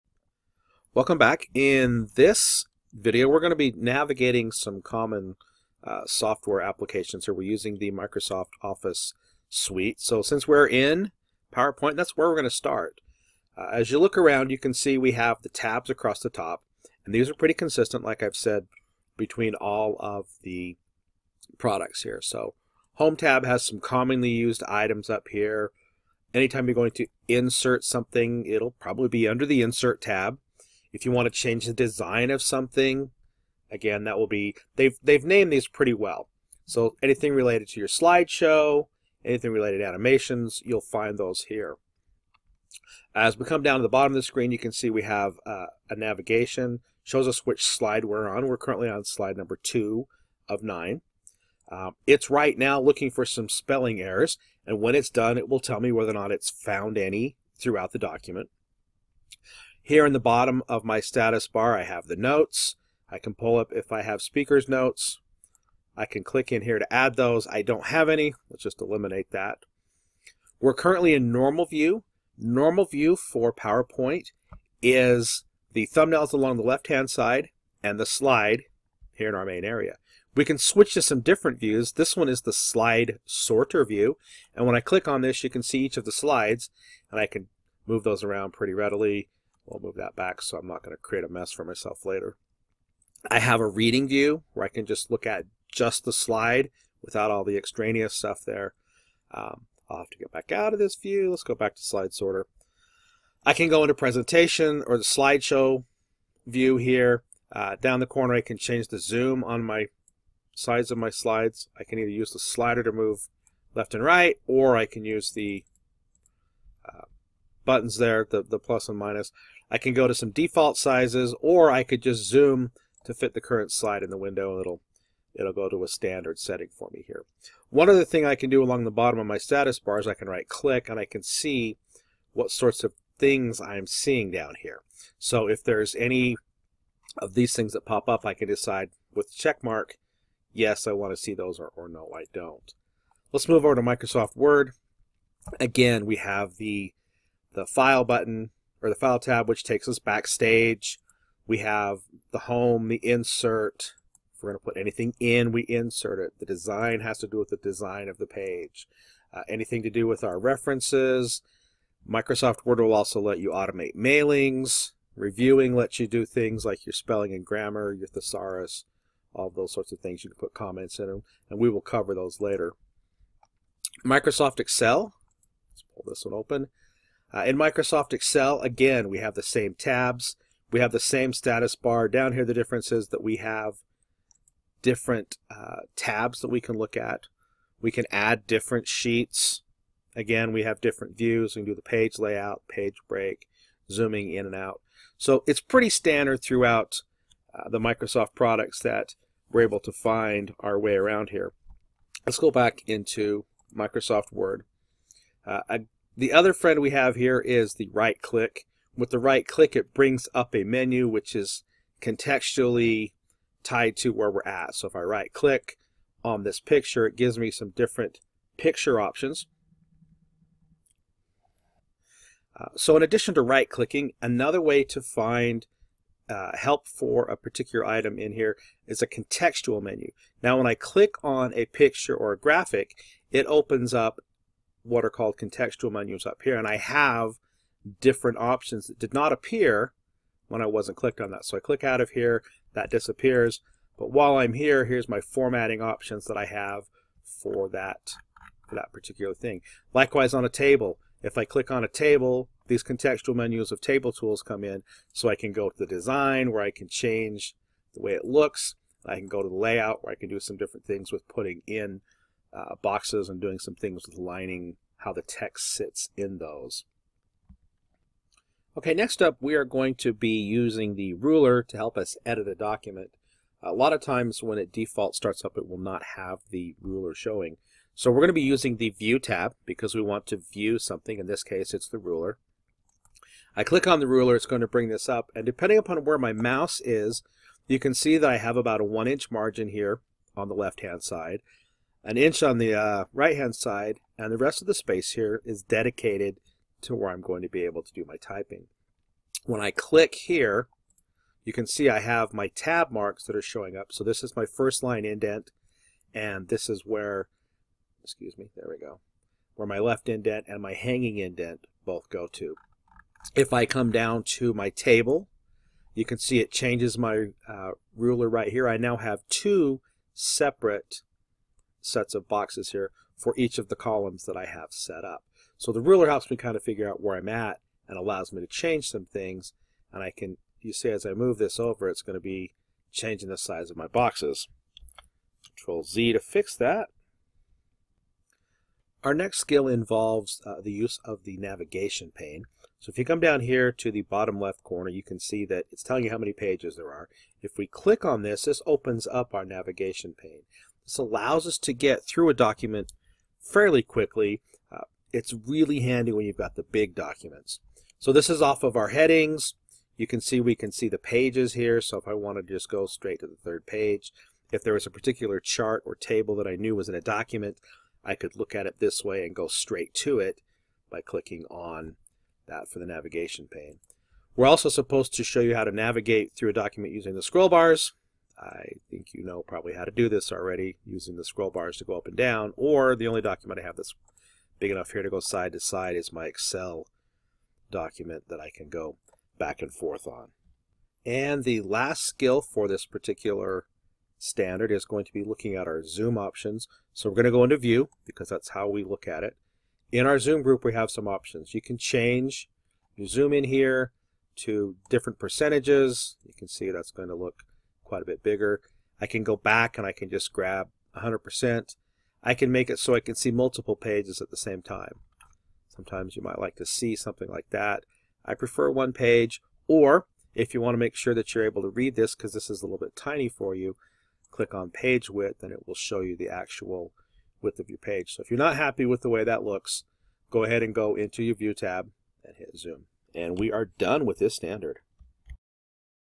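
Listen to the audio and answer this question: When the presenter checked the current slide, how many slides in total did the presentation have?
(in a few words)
9.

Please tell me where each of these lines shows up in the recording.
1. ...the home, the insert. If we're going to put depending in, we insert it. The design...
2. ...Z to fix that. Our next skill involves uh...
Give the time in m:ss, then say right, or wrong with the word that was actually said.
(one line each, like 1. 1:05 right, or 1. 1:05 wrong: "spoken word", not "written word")
1. 2:32 wrong: "anything", not "depending"
2. 5:35 right.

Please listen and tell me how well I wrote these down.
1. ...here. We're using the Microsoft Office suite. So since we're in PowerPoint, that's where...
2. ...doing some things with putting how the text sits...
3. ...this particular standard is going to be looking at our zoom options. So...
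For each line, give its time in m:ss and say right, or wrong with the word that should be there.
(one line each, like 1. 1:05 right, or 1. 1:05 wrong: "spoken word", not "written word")
1. 0:07 right
2. 4:23 wrong: "lining", not "putting"
3. 6:32 right.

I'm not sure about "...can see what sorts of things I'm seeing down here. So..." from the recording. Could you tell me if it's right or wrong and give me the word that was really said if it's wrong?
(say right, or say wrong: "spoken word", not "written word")
right.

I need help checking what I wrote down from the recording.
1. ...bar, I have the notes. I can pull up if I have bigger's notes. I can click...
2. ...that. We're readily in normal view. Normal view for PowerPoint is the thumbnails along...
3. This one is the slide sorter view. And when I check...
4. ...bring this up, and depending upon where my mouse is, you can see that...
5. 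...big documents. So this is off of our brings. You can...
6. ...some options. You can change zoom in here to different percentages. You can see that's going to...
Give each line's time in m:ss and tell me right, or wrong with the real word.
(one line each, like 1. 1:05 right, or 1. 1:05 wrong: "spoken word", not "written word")
1. 1:01 wrong: "speaker", not "bigger"
2. 1:09 wrong: "currently", not "readily"
3. 1:21 wrong: "click", not "check"
4. 4:44 right
5. 5:56 wrong: "headings", not "brings"
6. 6:40 right.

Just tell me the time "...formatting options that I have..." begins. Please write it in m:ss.
4:05.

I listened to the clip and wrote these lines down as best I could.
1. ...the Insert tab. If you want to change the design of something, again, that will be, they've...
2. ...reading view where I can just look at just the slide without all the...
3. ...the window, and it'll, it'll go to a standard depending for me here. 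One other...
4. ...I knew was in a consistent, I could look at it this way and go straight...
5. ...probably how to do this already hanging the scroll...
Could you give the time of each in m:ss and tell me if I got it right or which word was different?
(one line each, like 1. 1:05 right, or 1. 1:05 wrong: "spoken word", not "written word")
1. 0:29 right
2. 1:33 right
3. 2:04 wrong: "setting", not "depending"
4. 6:06 wrong: "document", not "consistent"
5. 6:19 wrong: "using", not "hanging".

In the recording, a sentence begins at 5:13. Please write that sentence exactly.
If I come down to my table you can see it changes my uh, ruler right here.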